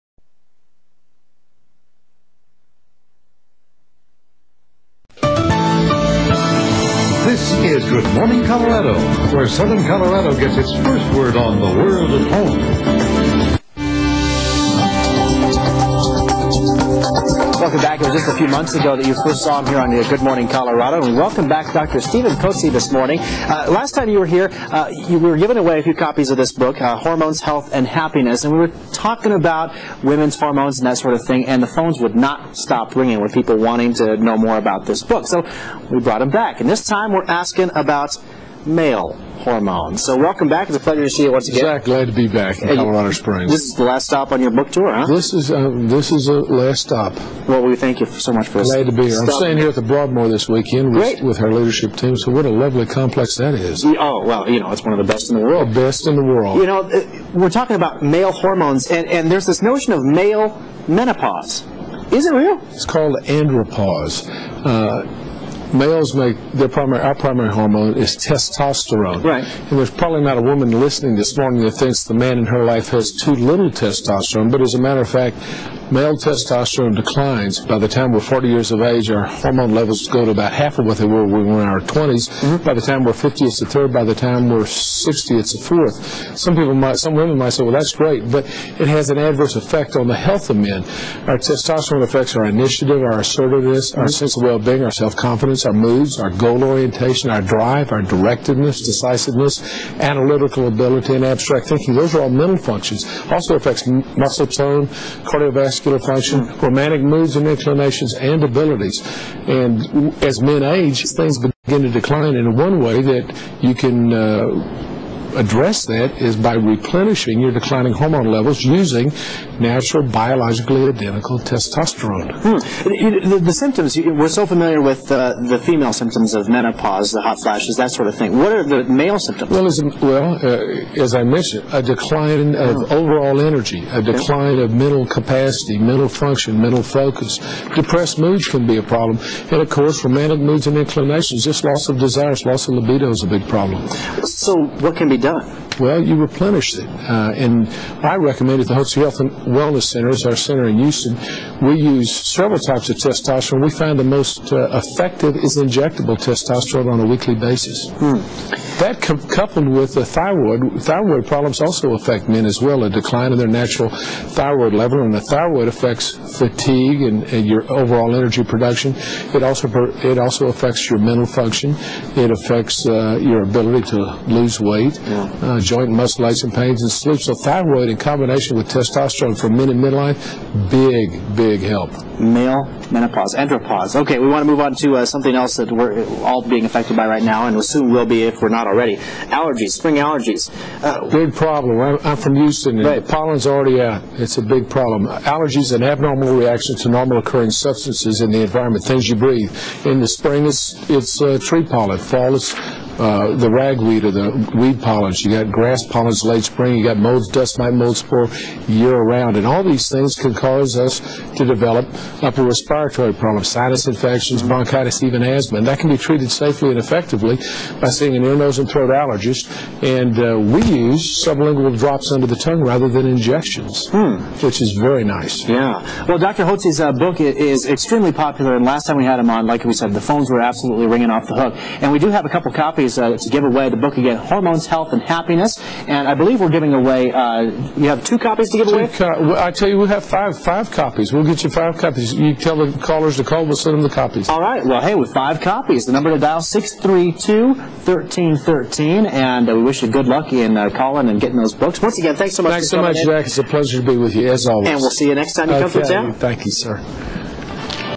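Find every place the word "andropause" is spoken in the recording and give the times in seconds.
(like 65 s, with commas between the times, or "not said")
63 s, 183 s.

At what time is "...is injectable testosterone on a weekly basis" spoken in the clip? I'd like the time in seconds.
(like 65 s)
155 s.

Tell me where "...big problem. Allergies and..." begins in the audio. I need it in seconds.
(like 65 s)
194 s.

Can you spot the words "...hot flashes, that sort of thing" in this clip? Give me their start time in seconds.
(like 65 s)
127 s.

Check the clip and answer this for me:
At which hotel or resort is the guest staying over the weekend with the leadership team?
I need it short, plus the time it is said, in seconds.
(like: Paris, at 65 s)
the Broadmoor, at 49 s.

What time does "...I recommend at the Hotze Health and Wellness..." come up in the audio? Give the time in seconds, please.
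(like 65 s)
148 s.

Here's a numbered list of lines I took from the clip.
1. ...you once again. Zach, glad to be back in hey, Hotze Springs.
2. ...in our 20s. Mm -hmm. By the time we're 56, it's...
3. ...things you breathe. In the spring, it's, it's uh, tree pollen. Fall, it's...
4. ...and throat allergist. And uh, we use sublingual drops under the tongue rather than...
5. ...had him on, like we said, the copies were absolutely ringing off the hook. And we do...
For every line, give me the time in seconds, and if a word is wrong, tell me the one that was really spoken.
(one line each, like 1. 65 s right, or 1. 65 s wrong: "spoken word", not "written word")
1. 41 s wrong: "Colorado", not "Hotze"
2. 81 s wrong: "50", not "56"
3. 198 s right
4. 218 s right
5. 229 s wrong: "phones", not "copies".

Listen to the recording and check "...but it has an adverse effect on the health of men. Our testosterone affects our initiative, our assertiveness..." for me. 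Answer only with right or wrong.
right.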